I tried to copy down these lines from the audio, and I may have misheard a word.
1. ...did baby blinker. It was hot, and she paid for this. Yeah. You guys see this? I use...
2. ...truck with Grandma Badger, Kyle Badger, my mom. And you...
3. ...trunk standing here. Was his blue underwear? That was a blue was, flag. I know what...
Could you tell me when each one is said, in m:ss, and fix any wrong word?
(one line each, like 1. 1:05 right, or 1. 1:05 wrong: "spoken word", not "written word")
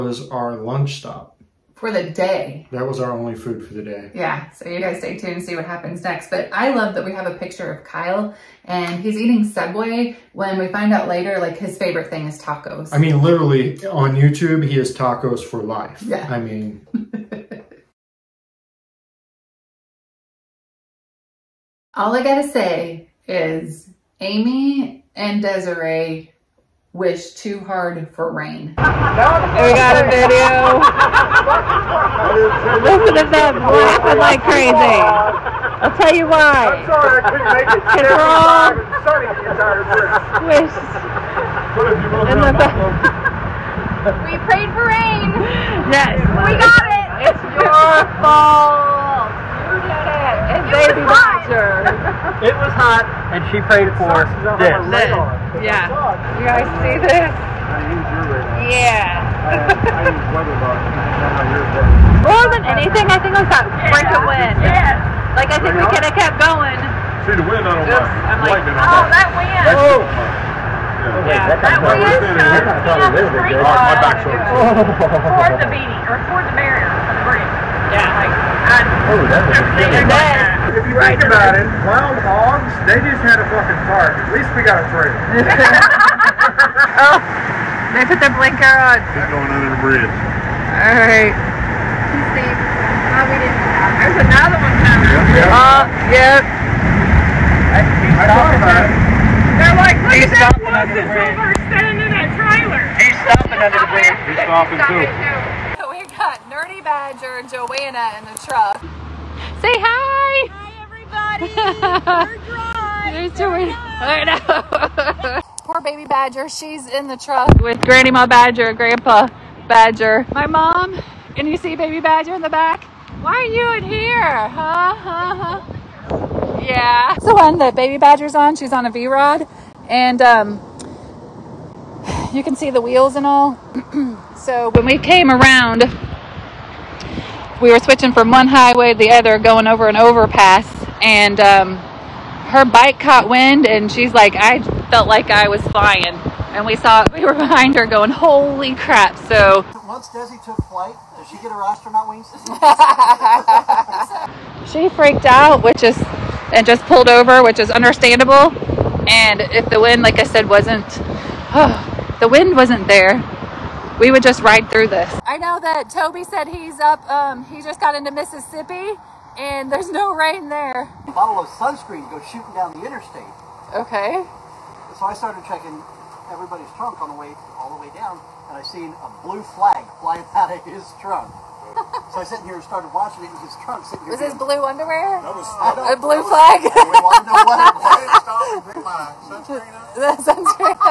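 1. 0:49 wrong: "bouncer", not "blinker"
2. 1:57 wrong: "Grandpa", not "Kyle"
3. 3:03 wrong: "sitting", not "standing".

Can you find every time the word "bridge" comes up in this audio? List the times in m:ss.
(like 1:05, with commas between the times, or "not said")
1:17, 1:29, 1:43.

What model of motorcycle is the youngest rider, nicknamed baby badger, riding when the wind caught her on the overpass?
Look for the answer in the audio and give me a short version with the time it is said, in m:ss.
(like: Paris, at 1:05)
V-Rod, at 2:08.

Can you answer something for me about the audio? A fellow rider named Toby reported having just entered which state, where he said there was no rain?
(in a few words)
Mississippi.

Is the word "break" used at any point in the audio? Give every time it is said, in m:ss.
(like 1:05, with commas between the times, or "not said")
1:03.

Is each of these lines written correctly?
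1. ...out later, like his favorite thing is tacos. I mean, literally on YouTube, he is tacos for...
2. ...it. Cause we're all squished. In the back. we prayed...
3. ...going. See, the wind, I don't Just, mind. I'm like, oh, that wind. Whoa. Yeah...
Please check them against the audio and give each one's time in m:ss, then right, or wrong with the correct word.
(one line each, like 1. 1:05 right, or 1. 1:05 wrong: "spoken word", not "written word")
1. 0:10 right
2. 0:37 right
3. 1:06 right.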